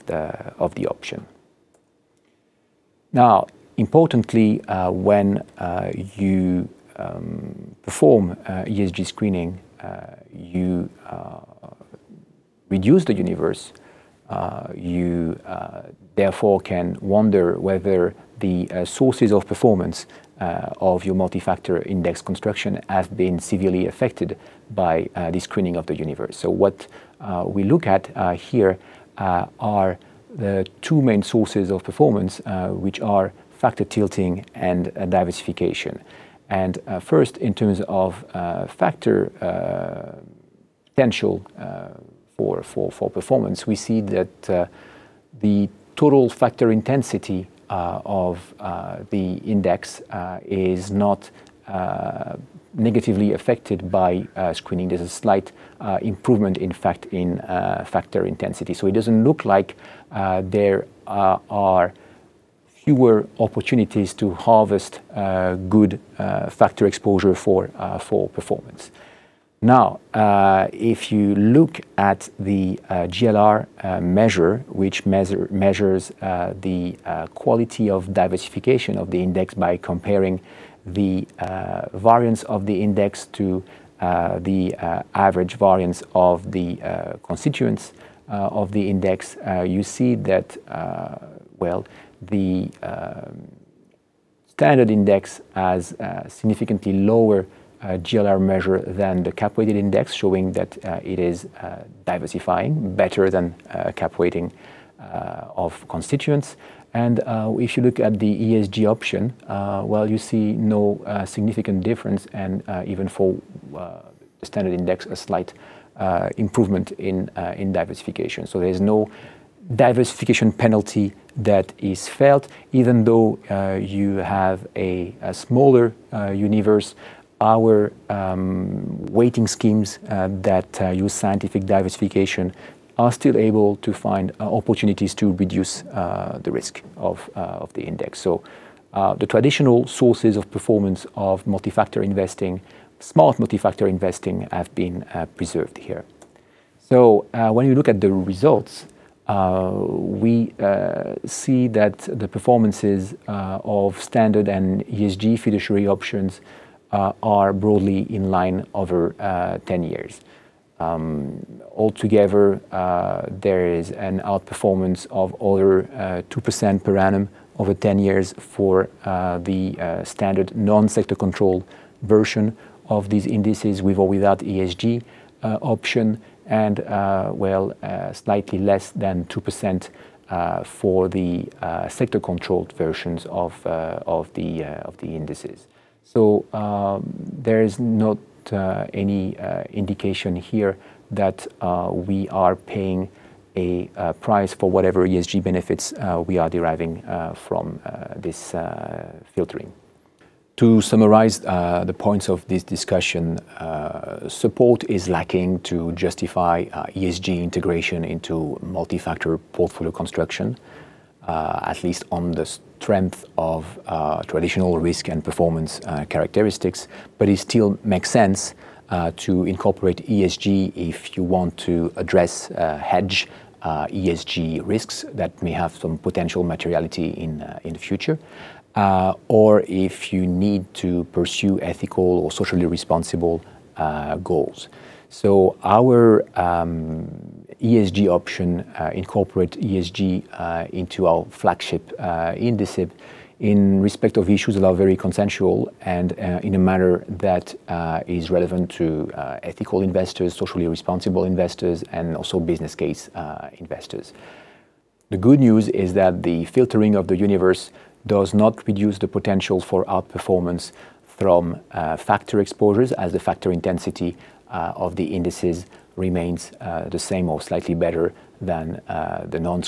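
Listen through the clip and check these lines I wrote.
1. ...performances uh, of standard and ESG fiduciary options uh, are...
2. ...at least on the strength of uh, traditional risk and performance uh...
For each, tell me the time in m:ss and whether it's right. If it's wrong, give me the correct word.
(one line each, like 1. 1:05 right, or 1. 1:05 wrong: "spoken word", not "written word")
1. 2:32 right
2. 3:31 right.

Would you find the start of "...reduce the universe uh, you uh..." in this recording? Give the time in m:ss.
0:12.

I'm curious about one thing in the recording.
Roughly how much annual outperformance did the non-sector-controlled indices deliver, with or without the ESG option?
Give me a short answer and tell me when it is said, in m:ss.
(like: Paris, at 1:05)
over 2% per annum, at 2:45.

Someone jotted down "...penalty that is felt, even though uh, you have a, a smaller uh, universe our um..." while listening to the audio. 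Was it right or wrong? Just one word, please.
right.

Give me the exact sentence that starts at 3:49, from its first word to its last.
or if you need to pursue ethical or socially responsible goals.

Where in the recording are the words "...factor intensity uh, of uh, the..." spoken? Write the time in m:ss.
0:46.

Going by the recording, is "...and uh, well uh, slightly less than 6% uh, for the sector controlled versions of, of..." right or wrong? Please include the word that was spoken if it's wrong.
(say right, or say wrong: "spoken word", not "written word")
wrong: "2", not "6".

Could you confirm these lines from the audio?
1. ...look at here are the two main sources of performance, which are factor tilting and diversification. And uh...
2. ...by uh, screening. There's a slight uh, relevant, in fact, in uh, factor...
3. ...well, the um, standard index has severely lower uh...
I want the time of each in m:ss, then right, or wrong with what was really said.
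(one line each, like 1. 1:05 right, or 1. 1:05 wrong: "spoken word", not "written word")
1. 0:27 right
2. 0:53 wrong: "improvement", not "relevant"
3. 1:31 wrong: "significantly", not "severely".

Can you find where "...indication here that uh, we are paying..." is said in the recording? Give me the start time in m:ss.
3:09.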